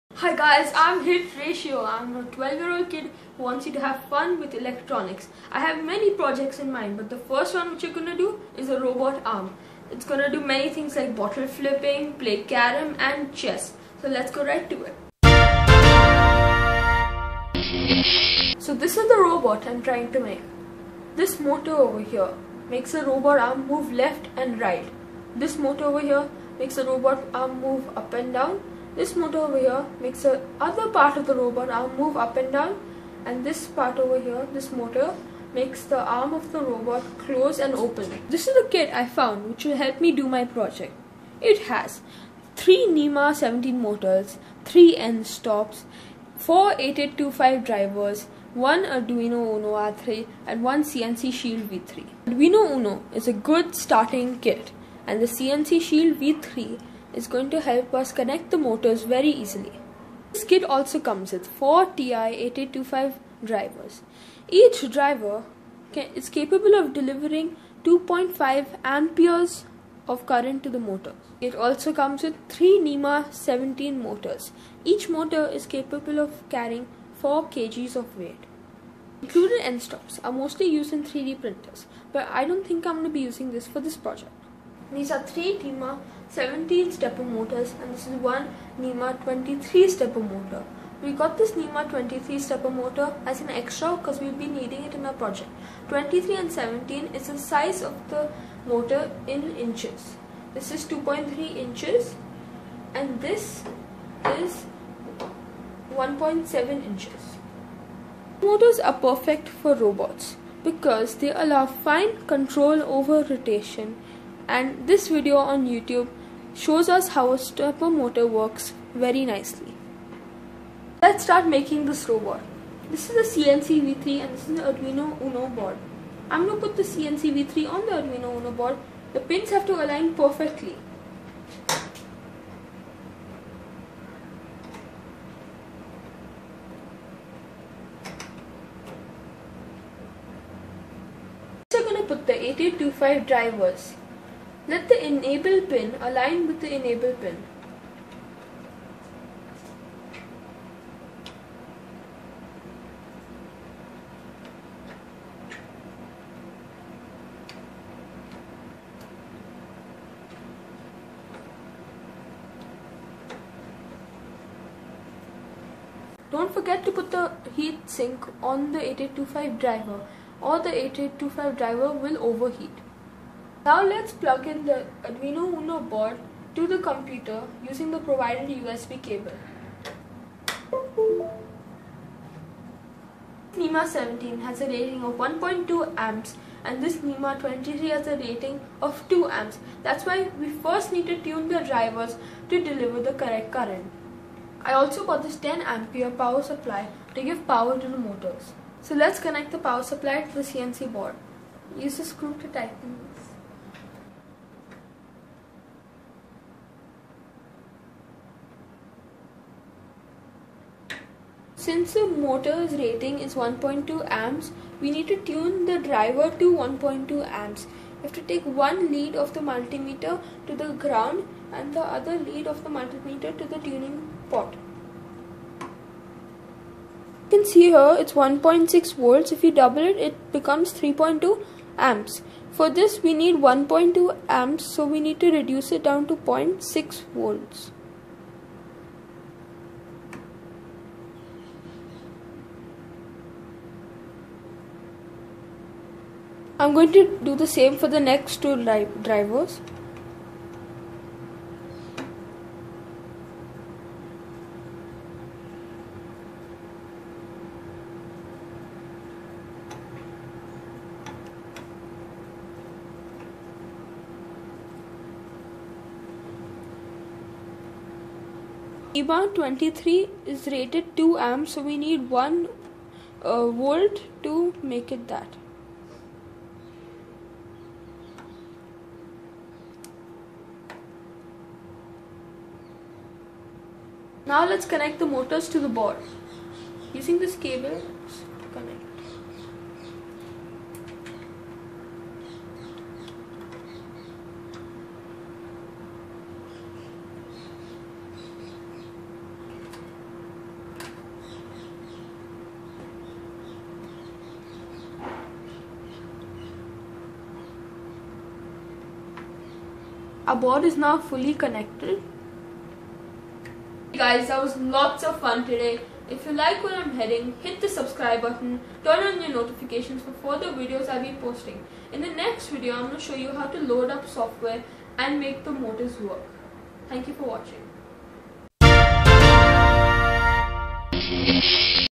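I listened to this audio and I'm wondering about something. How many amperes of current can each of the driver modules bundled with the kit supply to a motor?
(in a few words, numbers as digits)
2.5 amperes.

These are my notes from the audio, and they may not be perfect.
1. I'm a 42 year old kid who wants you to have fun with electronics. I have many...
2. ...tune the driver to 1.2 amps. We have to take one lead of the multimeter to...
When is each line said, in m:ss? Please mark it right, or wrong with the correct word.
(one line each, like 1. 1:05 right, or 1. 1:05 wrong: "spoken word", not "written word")
1. 0:01 wrong: "12", not "42"
2. 3:35 right.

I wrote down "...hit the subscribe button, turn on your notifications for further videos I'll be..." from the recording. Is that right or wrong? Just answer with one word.
right.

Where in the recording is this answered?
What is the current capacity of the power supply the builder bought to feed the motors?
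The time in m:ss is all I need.
3:15.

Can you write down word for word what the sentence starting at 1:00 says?
This kit also comes with 4 TI-8825 drivers.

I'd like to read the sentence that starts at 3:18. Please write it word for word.
So let's connect the power supply to the CNC board.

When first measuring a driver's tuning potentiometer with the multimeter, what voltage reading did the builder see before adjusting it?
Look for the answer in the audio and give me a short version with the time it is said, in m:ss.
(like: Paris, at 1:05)
1.6 volts, at 3:48.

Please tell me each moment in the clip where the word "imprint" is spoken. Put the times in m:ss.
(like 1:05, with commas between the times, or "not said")
not said.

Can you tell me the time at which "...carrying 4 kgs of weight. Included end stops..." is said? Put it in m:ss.
1:16.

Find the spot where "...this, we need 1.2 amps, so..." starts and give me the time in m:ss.
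3:52.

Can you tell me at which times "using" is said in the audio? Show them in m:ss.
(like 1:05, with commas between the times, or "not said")
1:23, 2:57, 4:46.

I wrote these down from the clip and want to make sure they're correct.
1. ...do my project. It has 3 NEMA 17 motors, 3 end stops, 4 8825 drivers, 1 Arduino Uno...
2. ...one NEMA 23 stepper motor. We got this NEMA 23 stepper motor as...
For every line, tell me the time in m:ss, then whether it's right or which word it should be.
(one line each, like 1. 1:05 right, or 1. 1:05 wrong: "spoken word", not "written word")
1. 0:40 right
2. 1:28 right.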